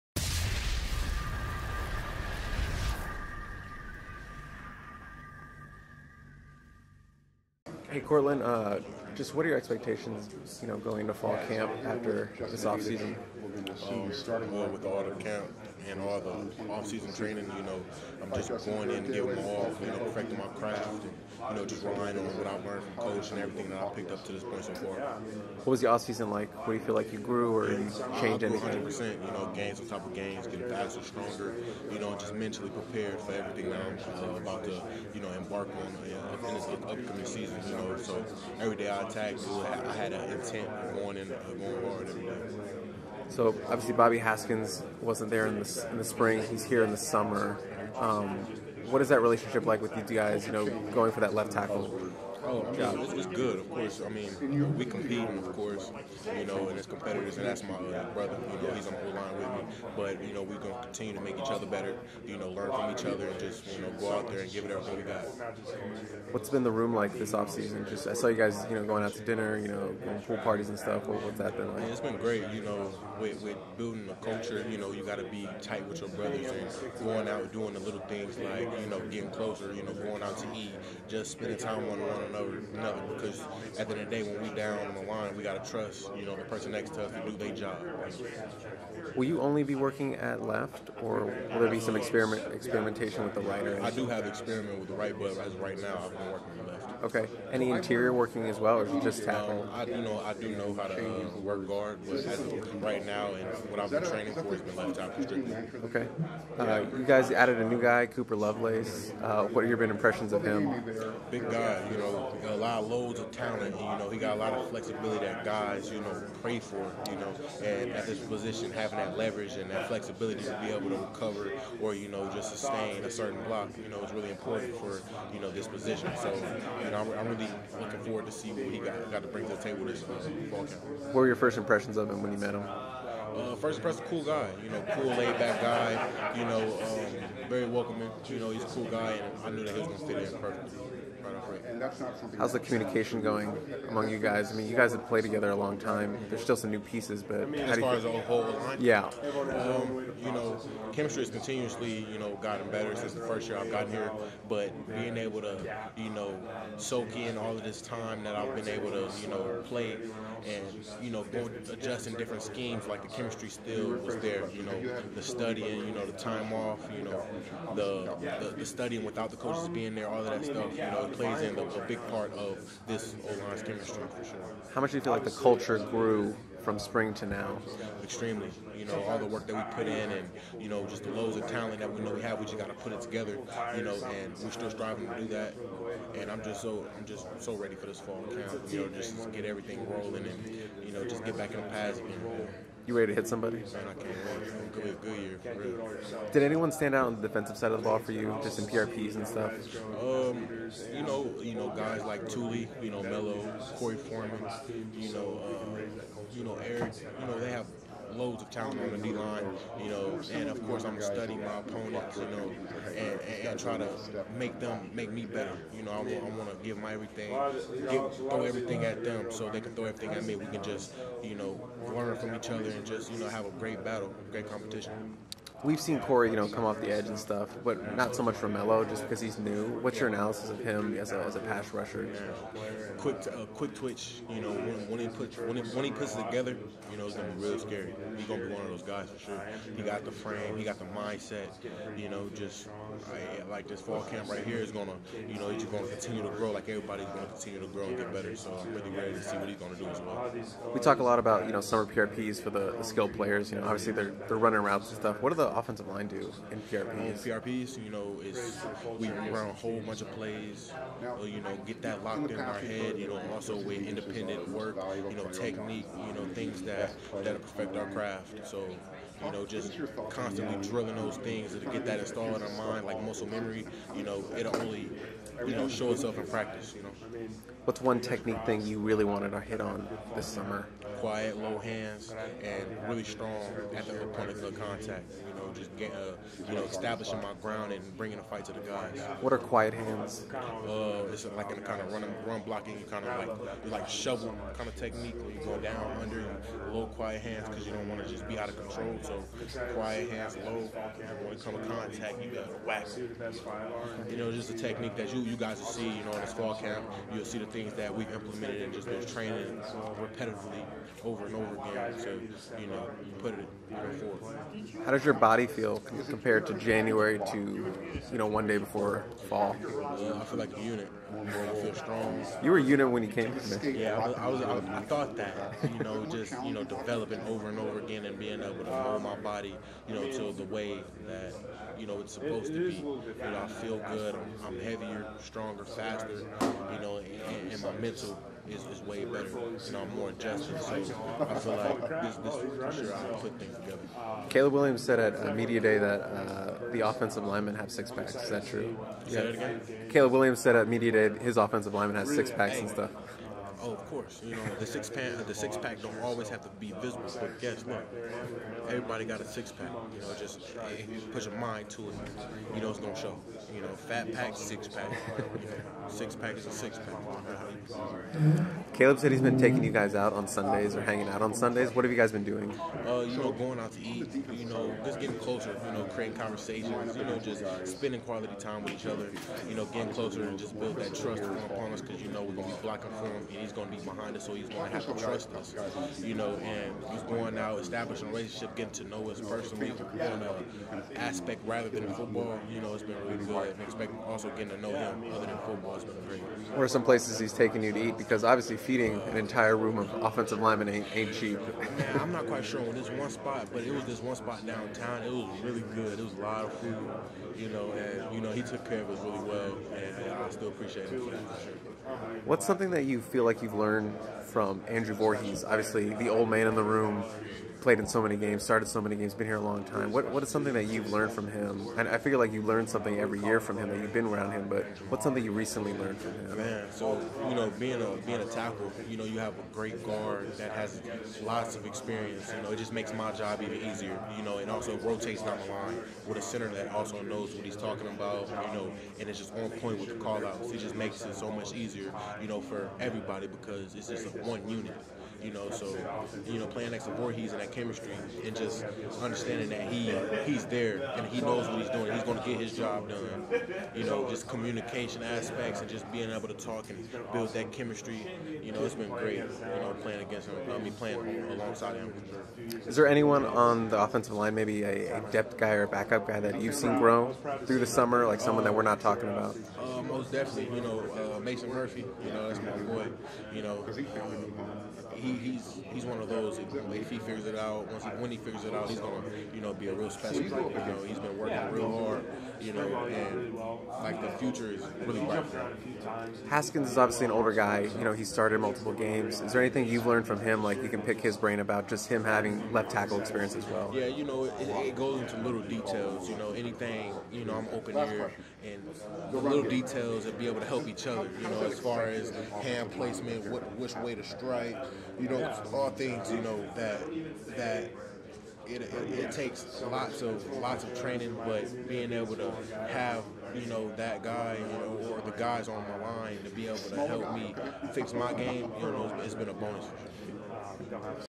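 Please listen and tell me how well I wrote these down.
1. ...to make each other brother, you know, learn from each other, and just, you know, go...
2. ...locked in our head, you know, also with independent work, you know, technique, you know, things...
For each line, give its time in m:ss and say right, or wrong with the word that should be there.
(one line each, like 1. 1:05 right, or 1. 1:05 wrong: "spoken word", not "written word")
1. 1:01 wrong: "better", not "brother"
2. 4:22 right.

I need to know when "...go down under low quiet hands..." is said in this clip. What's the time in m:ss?
4:55.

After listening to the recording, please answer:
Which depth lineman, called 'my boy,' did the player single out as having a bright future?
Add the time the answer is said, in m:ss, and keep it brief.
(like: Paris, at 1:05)
Mason Murphy, at 7:51.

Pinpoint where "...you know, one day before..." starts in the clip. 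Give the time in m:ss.
5:18.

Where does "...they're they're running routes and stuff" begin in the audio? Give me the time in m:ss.
4:13.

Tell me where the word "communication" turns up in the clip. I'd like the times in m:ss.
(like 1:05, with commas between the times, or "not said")
2:22, 7:34.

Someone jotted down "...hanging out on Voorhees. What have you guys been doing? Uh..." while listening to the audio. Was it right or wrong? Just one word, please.
wrong.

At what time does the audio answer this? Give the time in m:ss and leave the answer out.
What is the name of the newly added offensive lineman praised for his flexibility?
1:48.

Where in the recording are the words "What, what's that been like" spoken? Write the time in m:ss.
1:11.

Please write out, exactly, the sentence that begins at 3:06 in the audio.
And I'm just so I'm just so ready for this fall camp.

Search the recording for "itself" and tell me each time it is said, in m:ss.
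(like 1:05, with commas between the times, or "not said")
4:35.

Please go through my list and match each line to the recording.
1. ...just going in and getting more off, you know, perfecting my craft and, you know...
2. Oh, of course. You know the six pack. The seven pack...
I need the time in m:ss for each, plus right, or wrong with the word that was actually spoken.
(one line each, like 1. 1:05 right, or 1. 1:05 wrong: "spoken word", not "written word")
1. 0:18 right
2. 5:53 wrong: "six", not "seven".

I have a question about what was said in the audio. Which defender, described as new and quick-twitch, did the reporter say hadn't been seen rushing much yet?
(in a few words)
Melo.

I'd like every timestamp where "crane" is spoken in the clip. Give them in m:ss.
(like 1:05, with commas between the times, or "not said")
not said.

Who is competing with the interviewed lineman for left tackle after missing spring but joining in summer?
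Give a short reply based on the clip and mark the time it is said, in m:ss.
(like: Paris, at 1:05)
Bobby Haskins, at 0:43.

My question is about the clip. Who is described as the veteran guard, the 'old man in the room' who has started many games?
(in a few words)
Andrew Voorhees.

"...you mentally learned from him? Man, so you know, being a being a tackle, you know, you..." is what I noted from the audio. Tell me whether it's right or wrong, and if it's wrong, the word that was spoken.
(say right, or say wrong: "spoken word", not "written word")
wrong: "recently", not "mentally".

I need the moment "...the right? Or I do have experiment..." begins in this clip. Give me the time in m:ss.
1:33.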